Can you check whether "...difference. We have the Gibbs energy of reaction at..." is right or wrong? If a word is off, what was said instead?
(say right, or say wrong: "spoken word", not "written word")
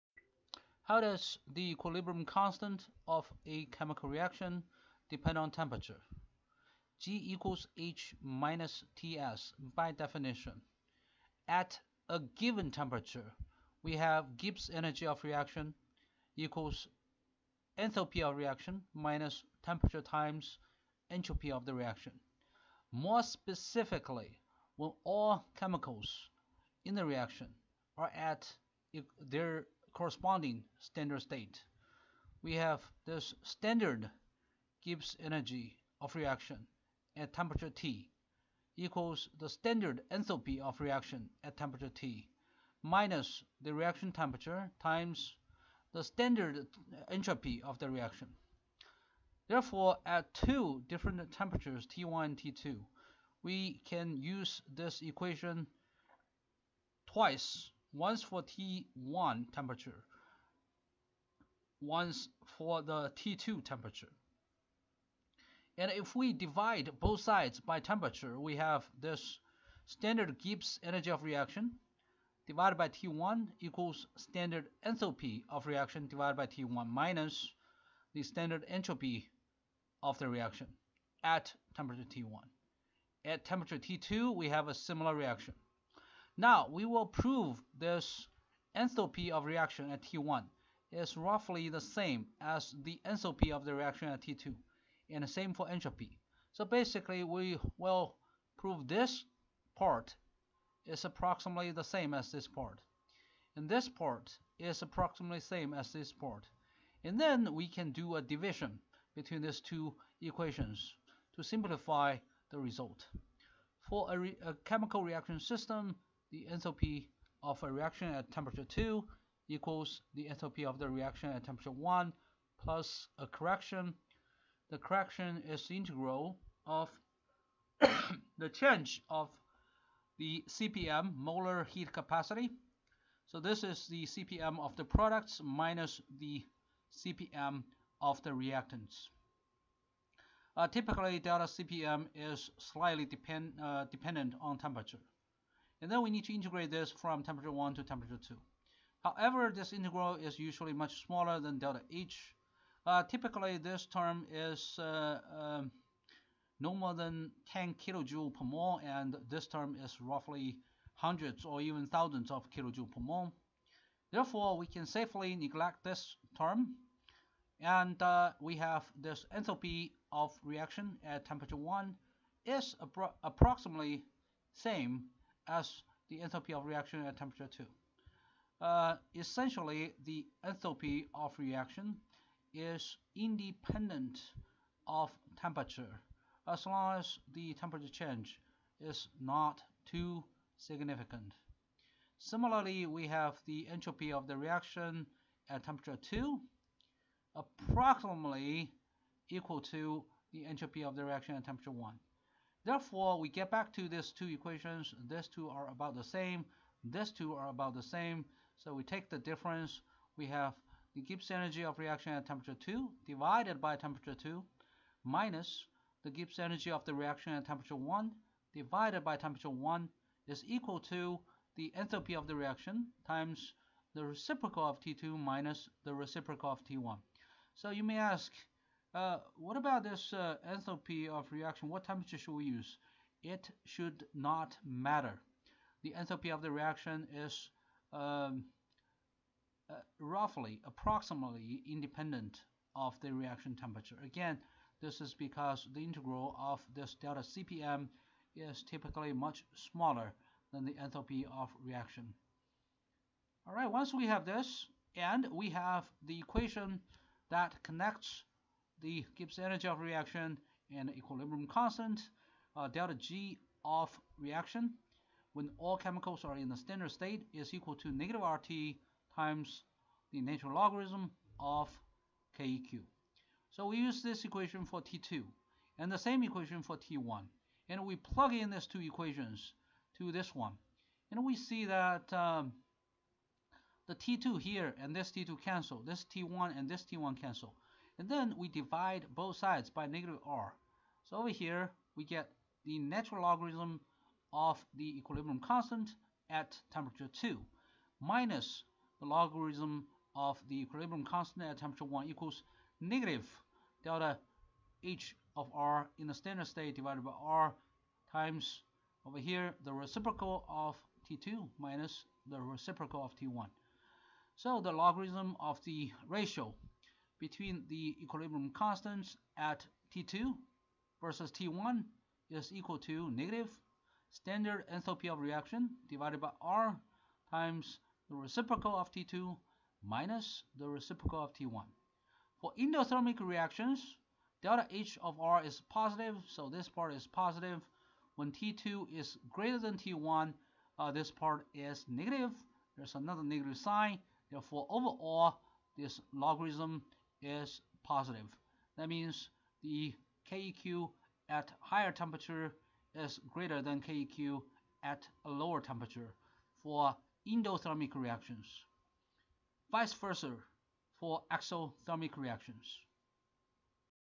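right.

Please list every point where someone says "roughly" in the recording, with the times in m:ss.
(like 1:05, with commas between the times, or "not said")
1:31, 2:39, 3:59.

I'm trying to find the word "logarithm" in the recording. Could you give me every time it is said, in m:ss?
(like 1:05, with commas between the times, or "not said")
4:30, 4:53, 4:59, 5:14, 5:46.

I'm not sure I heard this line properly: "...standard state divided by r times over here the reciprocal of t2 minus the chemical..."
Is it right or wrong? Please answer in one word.
wrong.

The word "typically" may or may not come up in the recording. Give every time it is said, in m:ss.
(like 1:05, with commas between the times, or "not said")
2:20, 2:33, 4:08.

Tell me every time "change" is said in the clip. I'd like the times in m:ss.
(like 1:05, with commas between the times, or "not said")
2:08, 3:07.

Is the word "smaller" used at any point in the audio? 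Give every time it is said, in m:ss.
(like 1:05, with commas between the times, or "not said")
2:31, 4:09.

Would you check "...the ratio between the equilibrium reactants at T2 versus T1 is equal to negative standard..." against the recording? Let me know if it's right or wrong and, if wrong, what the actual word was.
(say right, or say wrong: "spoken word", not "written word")
wrong: "constants", not "reactants".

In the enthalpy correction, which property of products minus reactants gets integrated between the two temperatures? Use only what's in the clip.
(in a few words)
Molar heat capacity.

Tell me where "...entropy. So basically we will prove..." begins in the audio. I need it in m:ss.
1:35.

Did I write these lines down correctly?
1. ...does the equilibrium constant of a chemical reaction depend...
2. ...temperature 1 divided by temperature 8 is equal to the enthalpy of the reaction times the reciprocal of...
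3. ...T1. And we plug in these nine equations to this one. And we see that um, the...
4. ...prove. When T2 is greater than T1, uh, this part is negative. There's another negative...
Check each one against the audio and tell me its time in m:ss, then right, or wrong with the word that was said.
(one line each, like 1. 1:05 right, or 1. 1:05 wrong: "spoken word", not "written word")
1. 0:00 right
2. 3:37 wrong: "1", not "8"
3. 4:36 wrong: "two", not "nine"
4. 5:37 wrong: "positive", not "prove".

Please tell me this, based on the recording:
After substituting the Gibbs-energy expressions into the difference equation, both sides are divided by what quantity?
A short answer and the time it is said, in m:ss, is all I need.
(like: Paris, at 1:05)
Negative R, at 4:49.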